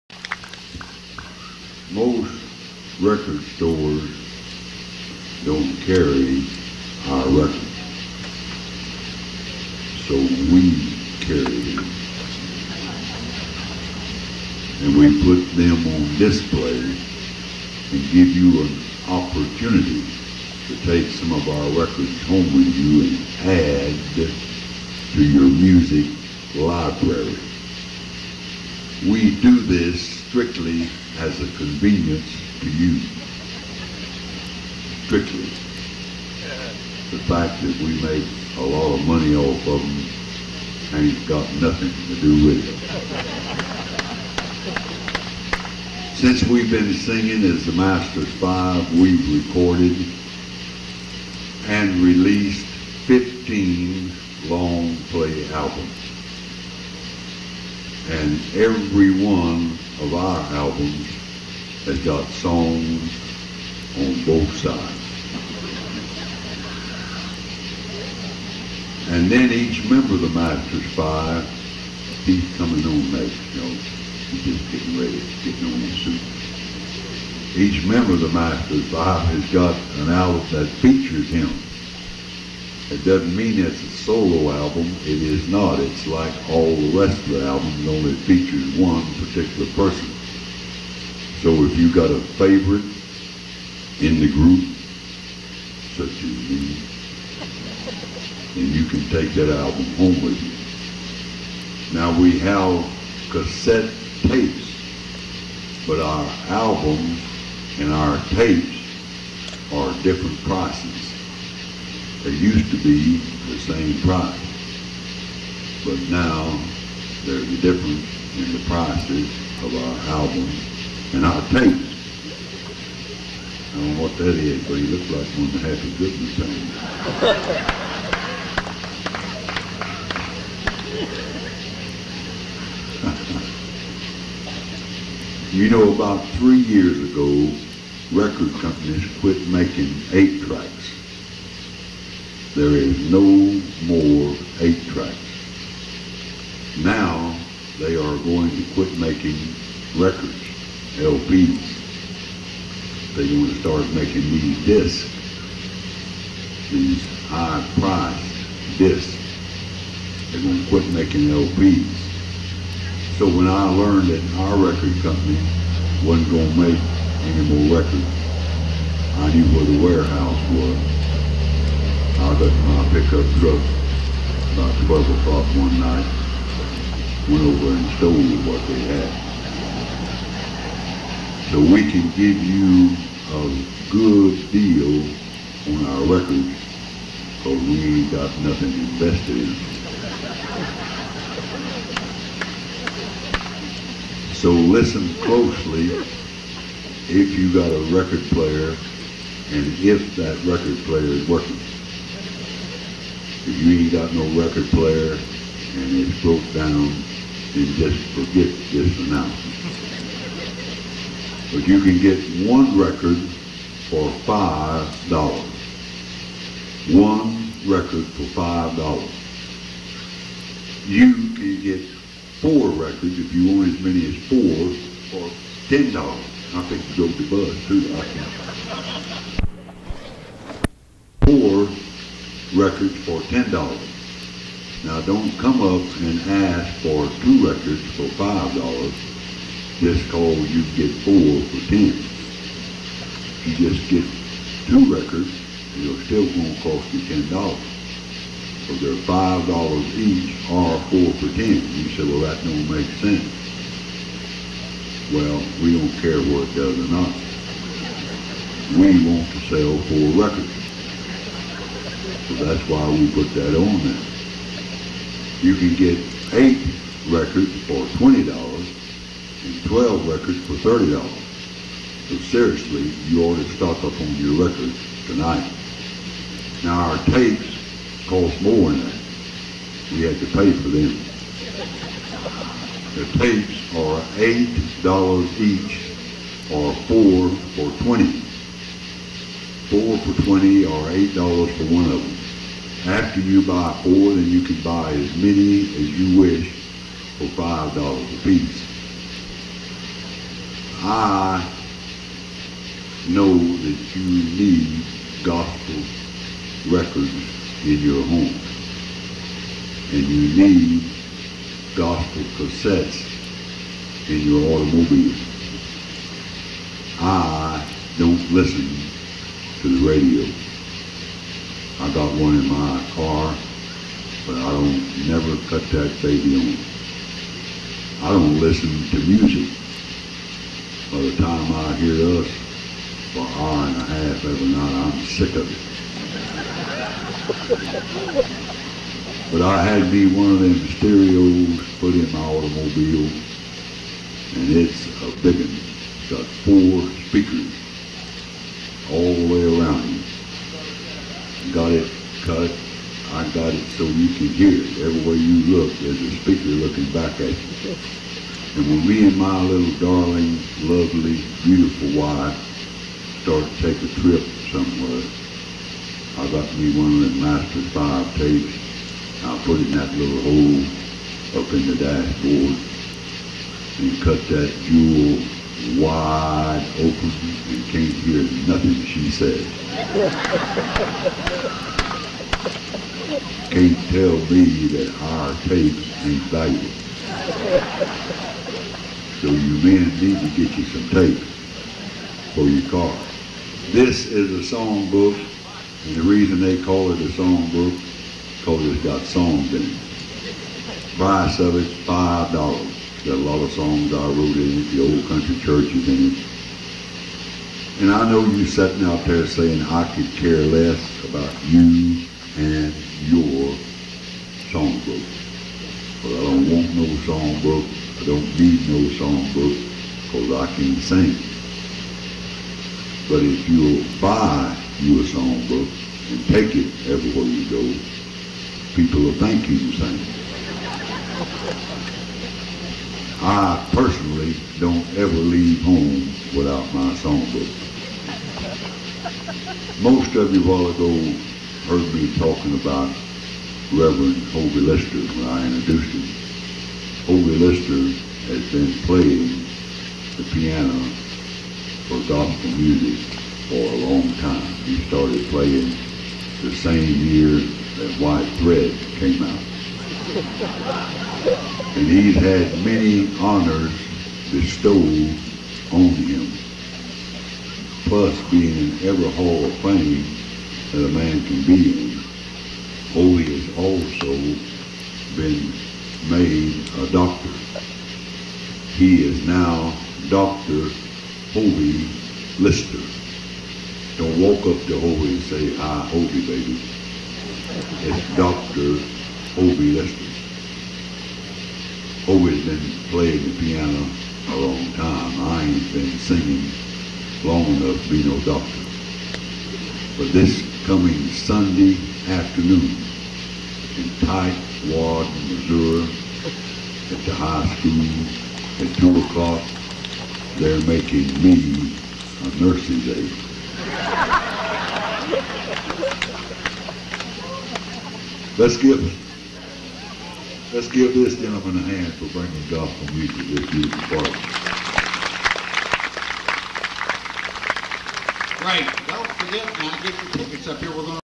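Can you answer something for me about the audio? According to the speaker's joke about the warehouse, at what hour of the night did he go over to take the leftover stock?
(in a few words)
12 o'clock.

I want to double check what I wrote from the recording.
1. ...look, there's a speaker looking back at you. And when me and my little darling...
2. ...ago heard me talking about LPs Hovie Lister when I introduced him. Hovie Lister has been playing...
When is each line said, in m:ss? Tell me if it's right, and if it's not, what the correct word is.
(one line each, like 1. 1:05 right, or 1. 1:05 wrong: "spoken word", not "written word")
1. 5:55 right
2. 7:20 wrong: "Reverend", not "LPs".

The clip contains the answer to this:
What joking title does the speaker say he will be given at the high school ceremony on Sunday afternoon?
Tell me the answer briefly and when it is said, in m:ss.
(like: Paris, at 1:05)
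nursing aide, at 8:32.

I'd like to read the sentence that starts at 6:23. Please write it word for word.
can't tell me that our faith ain't valuable.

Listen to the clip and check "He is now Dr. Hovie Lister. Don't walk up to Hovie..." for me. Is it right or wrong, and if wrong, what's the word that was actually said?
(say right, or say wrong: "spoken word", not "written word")
right.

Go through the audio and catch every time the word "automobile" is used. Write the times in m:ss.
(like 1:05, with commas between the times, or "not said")
5:14, 5:42.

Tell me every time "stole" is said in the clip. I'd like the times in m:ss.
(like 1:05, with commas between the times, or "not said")
2:57.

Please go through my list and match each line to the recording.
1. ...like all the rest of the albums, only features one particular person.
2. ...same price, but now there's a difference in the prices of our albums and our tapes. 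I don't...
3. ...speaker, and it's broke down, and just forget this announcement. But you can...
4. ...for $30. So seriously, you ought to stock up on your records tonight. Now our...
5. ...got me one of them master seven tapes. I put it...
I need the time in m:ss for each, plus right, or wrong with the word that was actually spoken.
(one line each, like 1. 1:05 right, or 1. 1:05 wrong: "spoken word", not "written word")
1. 1:26 right
2. 1:53 right
3. 3:24 wrong: "player", not "speaker"
4. 4:30 right
5. 6:06 wrong: "five", not "seven".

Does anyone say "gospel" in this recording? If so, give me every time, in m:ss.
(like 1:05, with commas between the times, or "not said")
5:05, 5:11, 7:32, 8:42.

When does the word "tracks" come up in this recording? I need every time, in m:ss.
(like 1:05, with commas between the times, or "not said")
2:20, 2:24.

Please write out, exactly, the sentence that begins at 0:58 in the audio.
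And every one of our albums has got songs on both sides.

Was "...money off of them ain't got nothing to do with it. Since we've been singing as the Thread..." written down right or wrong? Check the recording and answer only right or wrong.
wrong.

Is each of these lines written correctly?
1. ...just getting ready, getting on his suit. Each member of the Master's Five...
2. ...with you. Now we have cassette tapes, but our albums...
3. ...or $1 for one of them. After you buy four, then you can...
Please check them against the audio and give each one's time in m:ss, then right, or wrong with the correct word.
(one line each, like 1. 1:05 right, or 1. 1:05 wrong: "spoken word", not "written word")
1. 1:14 right
2. 1:40 right
3. 4:50 wrong: "8", not "1".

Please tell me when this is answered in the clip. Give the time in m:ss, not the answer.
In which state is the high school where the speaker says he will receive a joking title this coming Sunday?
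8:25.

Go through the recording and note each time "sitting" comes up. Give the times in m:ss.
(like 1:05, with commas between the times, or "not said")
6:48.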